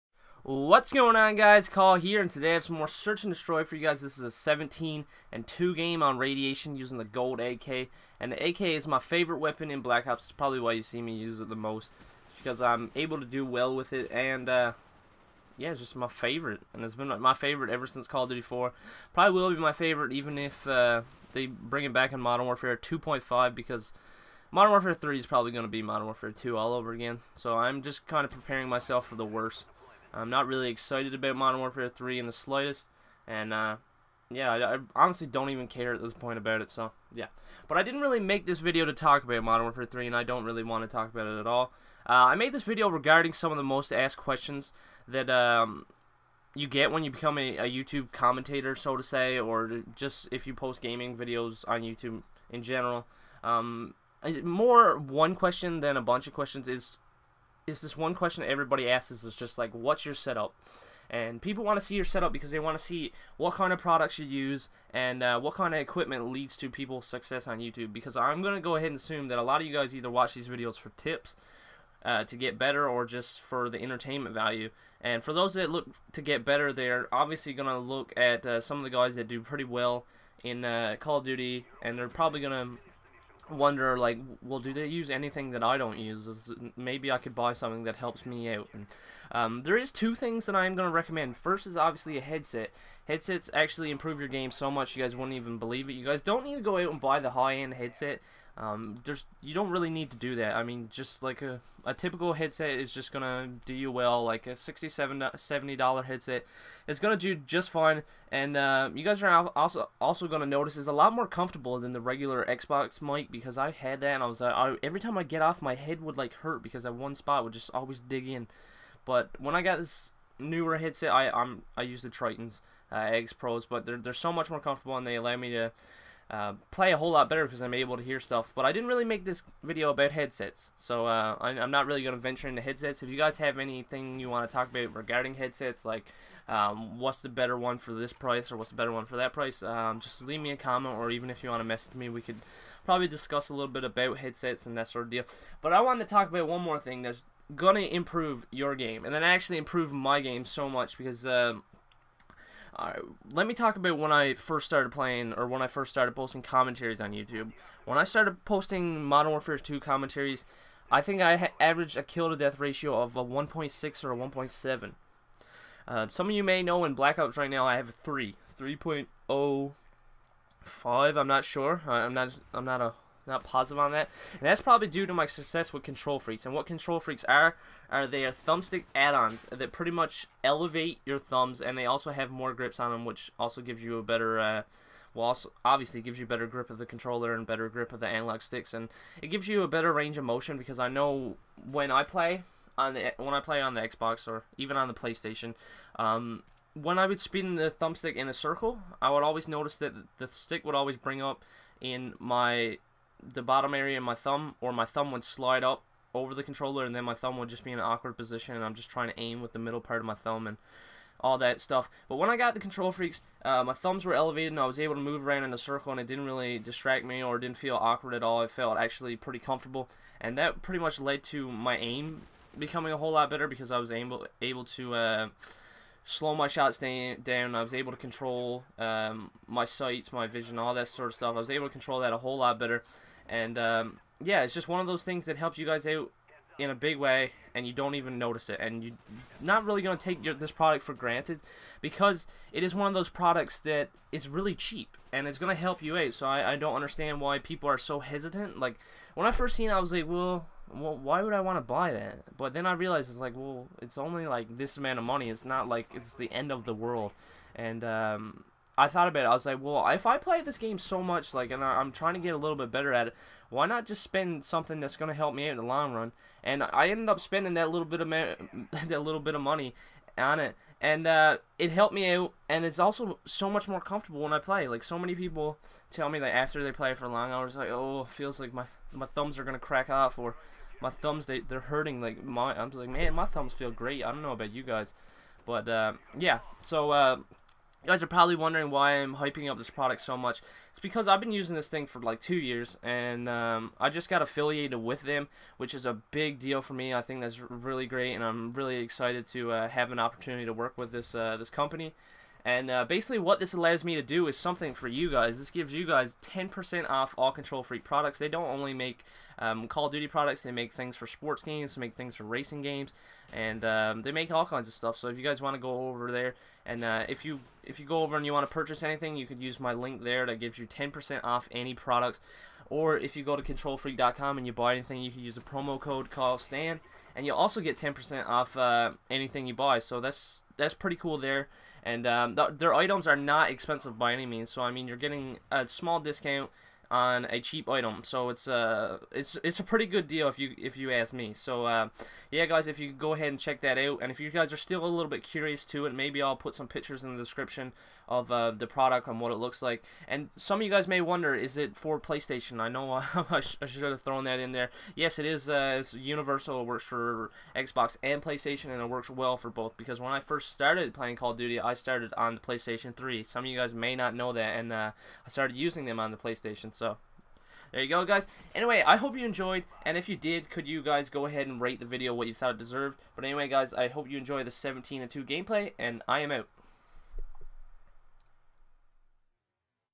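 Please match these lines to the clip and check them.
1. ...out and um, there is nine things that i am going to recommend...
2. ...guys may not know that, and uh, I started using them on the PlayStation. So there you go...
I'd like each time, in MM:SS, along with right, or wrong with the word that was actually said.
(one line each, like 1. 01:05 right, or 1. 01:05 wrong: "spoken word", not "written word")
1. 01:28 wrong: "two", not "nine"
2. 06:03 right.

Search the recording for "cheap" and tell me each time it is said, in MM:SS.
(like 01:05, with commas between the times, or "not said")
04:04, 05:37.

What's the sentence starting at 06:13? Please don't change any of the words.
But anyway, guys, I hope you enjoy the 17-2 gameplay, and I am out.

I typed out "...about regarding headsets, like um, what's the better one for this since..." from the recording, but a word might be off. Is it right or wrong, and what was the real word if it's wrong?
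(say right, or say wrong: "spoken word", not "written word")
wrong: "price", not "since".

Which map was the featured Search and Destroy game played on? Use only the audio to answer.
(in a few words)
Radiation.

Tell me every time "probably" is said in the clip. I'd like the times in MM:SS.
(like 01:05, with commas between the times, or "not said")
00:10, 00:19, 00:25, 01:22, 02:22, 02:54, 04:48.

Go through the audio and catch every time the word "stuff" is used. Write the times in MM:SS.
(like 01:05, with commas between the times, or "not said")
02:08, 03:31, 03:51, 05:14.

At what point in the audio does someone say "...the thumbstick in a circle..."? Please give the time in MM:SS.
03:17.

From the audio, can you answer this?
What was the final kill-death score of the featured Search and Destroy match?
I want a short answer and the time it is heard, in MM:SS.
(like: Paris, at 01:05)
17 and 2, at 00:04.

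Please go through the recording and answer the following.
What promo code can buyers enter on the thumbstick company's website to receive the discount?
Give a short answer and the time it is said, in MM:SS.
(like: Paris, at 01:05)
Stan, at 05:26.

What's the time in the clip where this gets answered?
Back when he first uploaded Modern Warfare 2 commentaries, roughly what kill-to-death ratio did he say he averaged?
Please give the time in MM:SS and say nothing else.
02:43.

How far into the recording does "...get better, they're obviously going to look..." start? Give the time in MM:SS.
01:16.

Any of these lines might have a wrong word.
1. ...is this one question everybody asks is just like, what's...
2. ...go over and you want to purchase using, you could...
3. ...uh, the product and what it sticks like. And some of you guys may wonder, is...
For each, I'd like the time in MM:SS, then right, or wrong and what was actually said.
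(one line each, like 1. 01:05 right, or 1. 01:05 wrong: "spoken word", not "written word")
1. 00:57 right
2. 05:17 wrong: "anything", not "using"
3. 05:48 wrong: "looks", not "sticks".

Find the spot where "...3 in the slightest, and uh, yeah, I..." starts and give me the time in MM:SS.
00:31.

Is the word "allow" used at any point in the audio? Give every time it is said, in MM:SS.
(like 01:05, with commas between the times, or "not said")
02:05, 05:03.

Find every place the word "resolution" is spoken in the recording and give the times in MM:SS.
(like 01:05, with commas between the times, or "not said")
not said.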